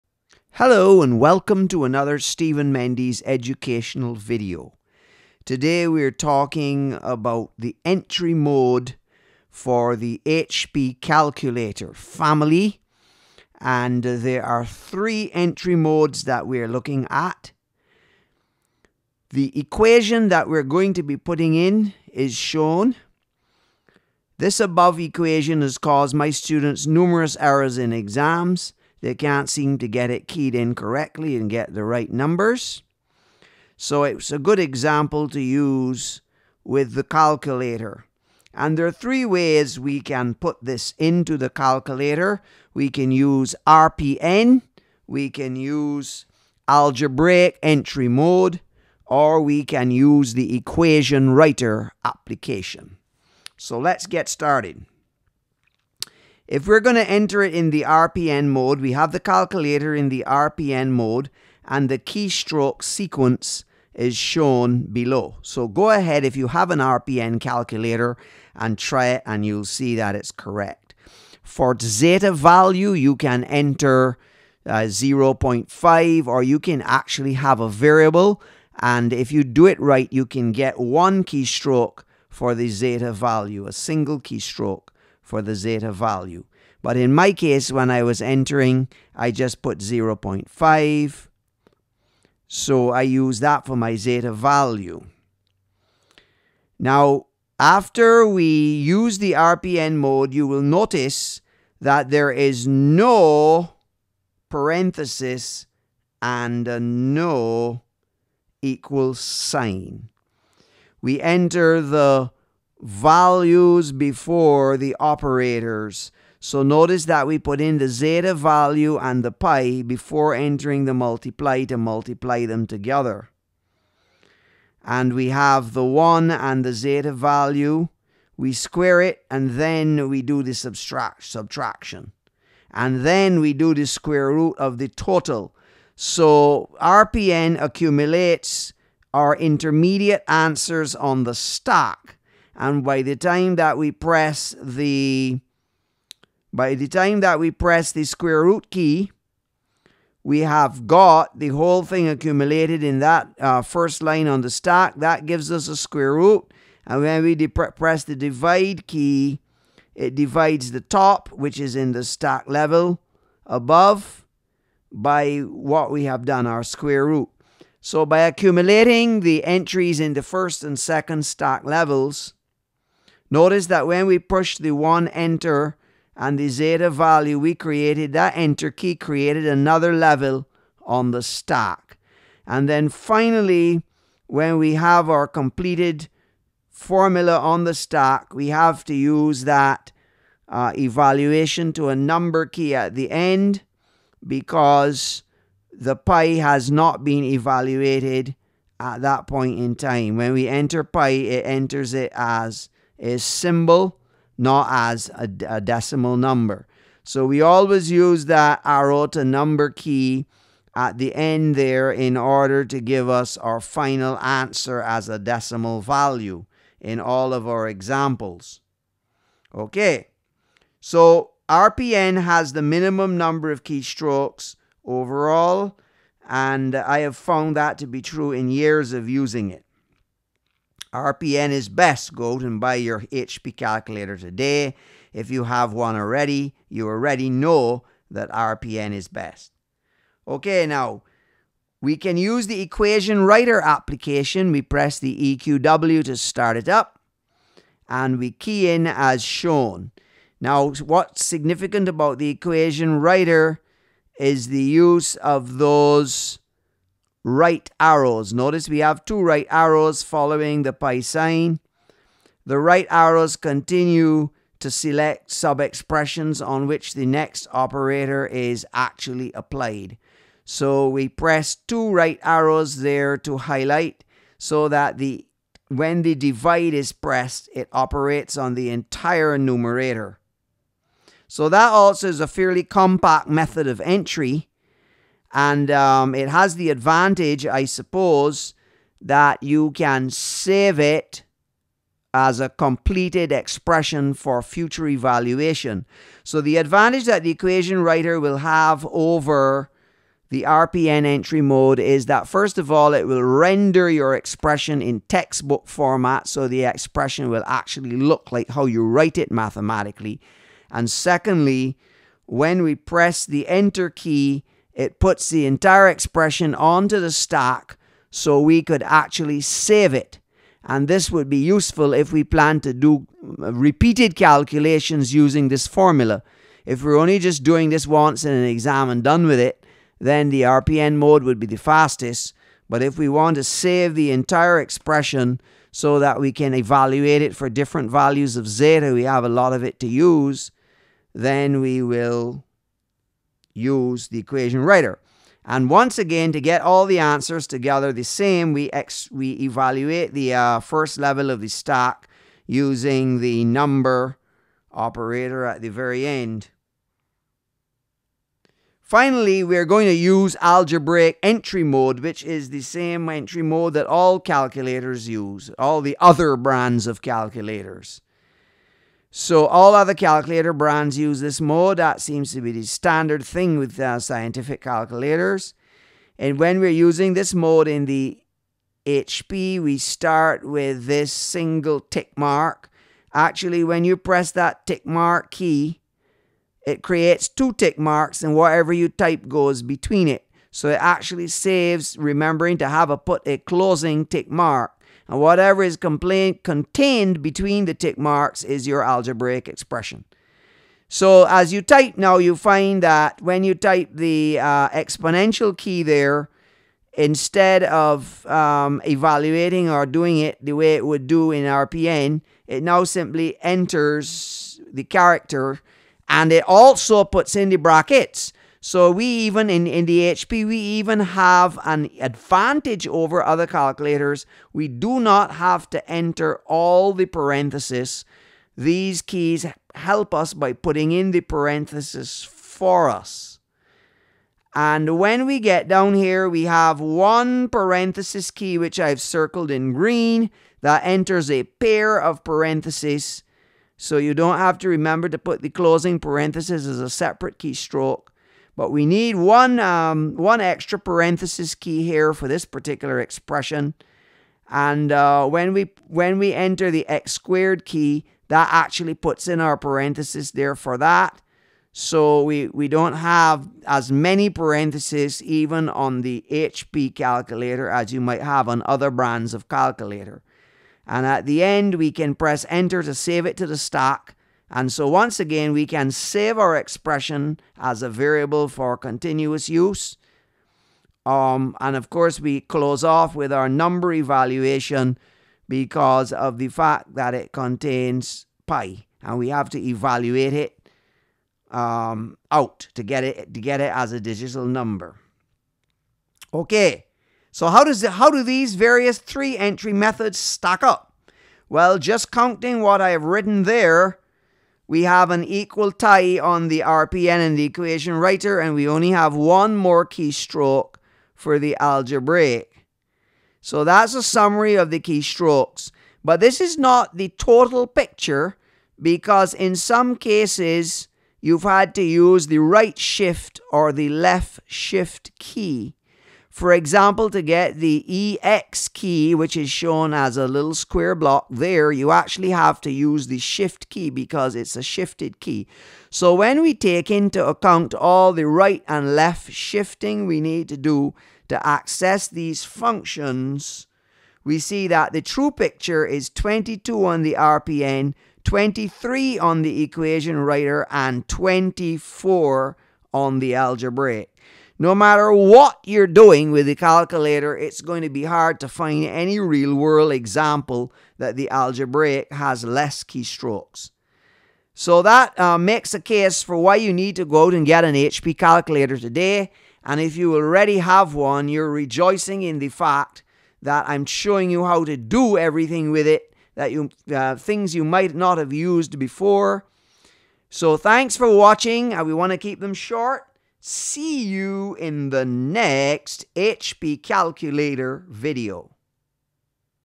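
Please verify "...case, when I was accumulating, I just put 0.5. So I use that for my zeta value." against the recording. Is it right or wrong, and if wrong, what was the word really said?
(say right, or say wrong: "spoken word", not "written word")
wrong: "entering", not "accumulating".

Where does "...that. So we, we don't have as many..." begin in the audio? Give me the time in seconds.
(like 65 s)
460 s.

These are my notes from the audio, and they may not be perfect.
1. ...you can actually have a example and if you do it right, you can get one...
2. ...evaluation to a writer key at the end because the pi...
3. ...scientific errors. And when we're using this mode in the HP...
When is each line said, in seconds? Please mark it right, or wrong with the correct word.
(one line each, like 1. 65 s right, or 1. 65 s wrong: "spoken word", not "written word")
1. 76 s wrong: "variable", not "example"
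2. 190 s wrong: "number", not "writer"
3. 373 s wrong: "calculators", not "errors".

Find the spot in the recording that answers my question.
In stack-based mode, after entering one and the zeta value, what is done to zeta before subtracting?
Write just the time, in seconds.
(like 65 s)
128 s.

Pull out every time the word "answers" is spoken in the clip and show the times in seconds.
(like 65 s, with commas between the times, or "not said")
140 s, 214 s, 346 s.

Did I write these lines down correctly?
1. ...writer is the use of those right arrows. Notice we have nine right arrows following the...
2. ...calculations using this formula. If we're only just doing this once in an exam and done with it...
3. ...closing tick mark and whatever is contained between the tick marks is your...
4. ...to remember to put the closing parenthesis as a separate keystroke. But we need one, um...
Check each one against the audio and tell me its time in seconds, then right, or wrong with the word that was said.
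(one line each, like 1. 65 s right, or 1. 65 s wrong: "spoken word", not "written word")
1. 252 s wrong: "two", not "nine"
2. 324 s right
3. 393 s right
4. 444 s right.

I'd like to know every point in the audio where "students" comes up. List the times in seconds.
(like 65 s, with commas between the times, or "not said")
26 s.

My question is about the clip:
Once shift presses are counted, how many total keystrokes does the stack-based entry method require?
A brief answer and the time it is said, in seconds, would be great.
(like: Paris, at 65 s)
22, at 546 s.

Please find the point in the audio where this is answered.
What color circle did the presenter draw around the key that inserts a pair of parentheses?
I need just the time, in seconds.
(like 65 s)
439 s.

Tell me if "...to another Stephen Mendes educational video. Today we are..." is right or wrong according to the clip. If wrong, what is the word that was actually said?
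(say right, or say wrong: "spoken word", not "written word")
right.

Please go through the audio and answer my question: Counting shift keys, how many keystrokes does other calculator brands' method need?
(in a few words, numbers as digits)
24.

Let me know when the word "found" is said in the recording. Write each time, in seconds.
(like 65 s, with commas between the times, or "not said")
227 s.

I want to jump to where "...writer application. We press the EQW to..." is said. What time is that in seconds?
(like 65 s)
243 s.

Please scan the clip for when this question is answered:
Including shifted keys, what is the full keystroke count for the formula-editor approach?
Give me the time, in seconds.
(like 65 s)
548 s.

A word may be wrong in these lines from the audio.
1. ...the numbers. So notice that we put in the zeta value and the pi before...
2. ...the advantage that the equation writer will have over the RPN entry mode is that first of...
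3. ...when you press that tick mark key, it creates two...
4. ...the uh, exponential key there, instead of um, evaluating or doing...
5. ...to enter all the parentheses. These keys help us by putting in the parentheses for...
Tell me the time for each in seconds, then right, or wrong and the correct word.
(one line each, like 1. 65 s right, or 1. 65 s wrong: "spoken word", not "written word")
1. 114 s wrong: "operators", not "numbers"
2. 296 s right
3. 383 s right
4. 403 s right
5. 425 s right.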